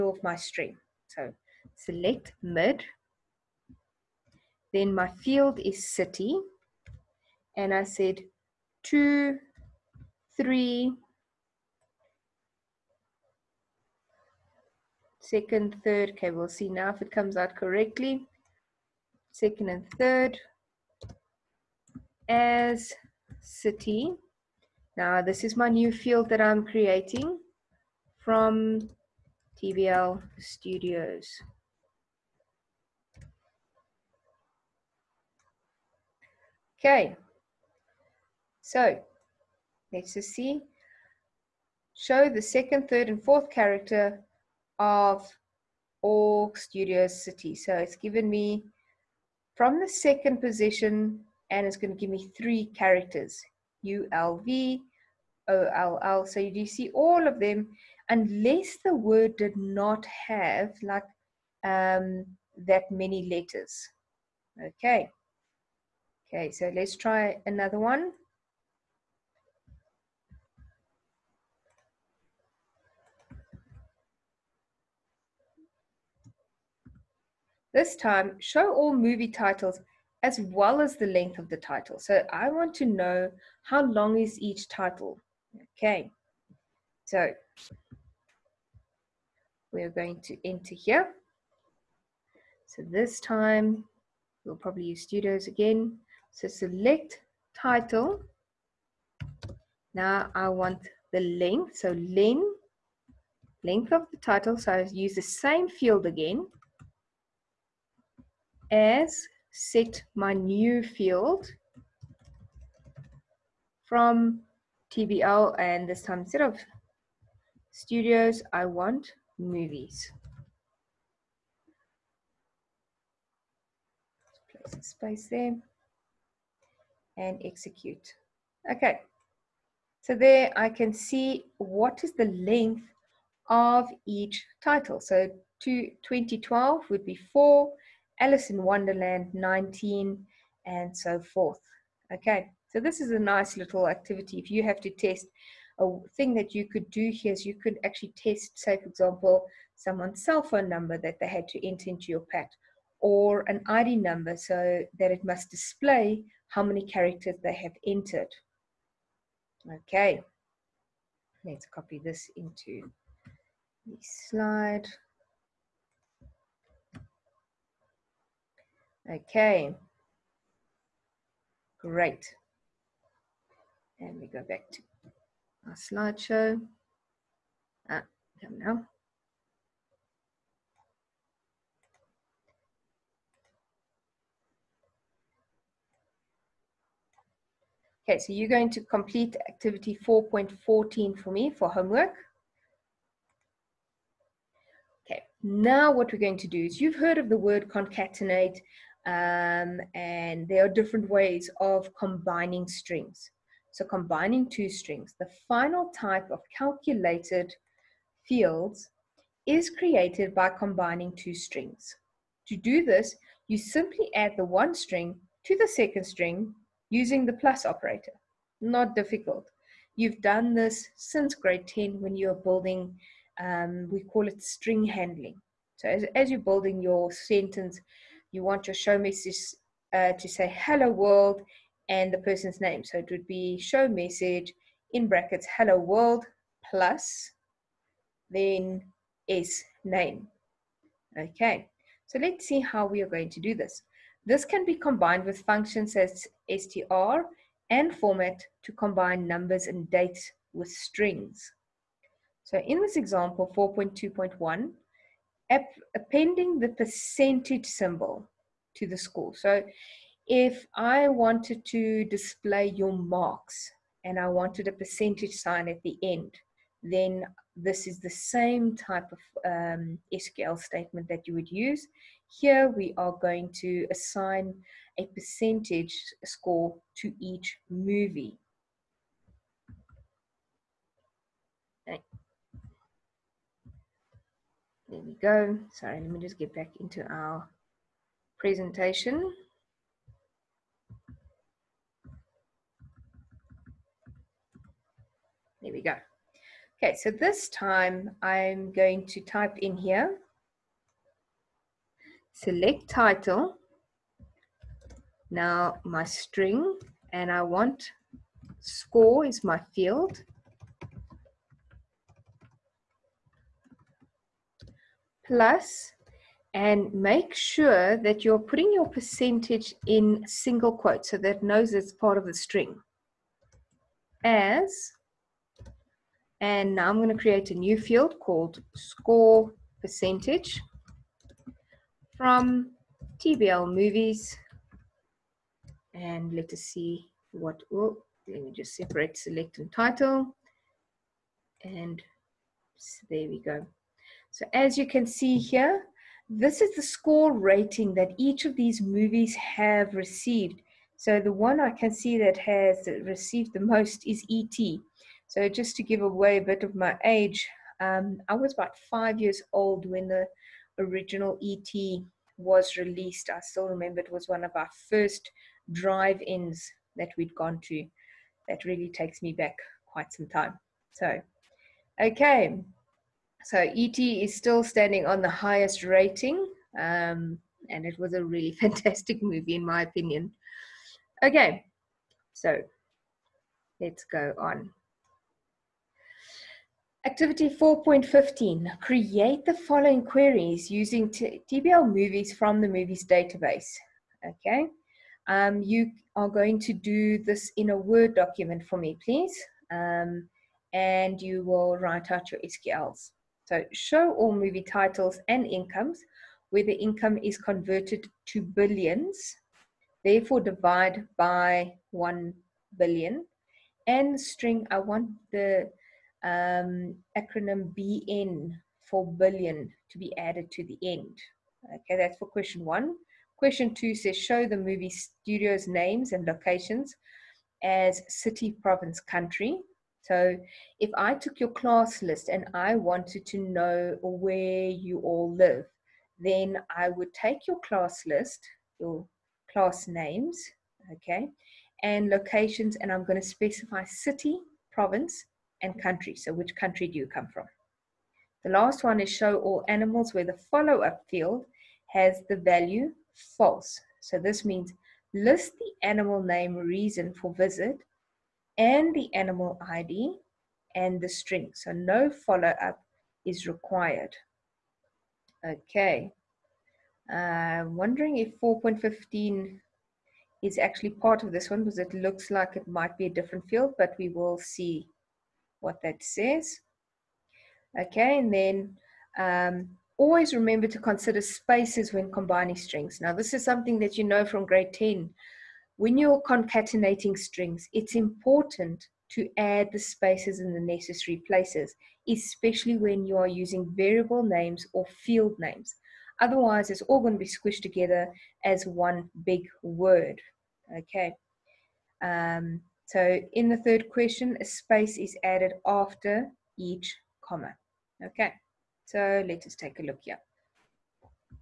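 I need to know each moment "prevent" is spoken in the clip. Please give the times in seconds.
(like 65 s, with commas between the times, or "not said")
not said.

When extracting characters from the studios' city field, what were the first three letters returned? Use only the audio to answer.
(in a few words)
ULV.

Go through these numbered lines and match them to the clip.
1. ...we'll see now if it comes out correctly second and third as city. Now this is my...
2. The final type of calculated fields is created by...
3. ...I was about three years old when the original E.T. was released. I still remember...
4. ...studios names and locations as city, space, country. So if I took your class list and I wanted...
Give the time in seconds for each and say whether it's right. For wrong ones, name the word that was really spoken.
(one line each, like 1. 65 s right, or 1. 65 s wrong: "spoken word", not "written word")
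1. 16 s right
2. 205 s right
3. 358 s wrong: "five", not "three"
4. 424 s wrong: "province", not "space".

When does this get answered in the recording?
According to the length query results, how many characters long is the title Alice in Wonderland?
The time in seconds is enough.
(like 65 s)
139 s.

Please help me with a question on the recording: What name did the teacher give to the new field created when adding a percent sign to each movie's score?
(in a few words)
score percentage.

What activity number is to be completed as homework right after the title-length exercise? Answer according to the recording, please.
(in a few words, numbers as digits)
4.14.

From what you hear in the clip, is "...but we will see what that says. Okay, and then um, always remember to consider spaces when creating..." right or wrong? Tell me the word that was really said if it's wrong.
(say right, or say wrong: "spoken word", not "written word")
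wrong: "combining", not "creating".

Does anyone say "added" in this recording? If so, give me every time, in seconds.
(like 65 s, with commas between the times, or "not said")
420 s, 505 s.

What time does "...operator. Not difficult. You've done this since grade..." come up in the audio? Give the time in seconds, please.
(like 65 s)
217 s.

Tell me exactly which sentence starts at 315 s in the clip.
plus and make sure that you're putting your percentage in single quotes so that it knows it's part of the string.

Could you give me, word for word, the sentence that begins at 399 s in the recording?
Um, and you will write out your SQLs.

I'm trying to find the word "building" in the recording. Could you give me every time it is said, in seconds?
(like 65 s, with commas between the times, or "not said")
222 s, 226 s.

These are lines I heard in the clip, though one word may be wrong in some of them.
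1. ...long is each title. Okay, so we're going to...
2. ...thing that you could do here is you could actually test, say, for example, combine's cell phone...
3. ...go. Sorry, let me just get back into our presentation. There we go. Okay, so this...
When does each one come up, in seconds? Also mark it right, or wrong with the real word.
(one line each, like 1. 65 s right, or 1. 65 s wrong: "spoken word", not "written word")
1. 83 s right
2. 146 s wrong: "someone", not "combine"
3. 285 s right.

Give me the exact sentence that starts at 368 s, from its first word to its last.
That really takes me back quite some time.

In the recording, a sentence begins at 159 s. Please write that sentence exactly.
Okay, let's copy this into the slide.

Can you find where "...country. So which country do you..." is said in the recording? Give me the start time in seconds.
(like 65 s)
445 s.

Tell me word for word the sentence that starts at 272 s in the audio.
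Here we are going to assign a percentage score to each movie.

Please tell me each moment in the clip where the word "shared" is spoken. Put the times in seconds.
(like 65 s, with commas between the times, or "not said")
not said.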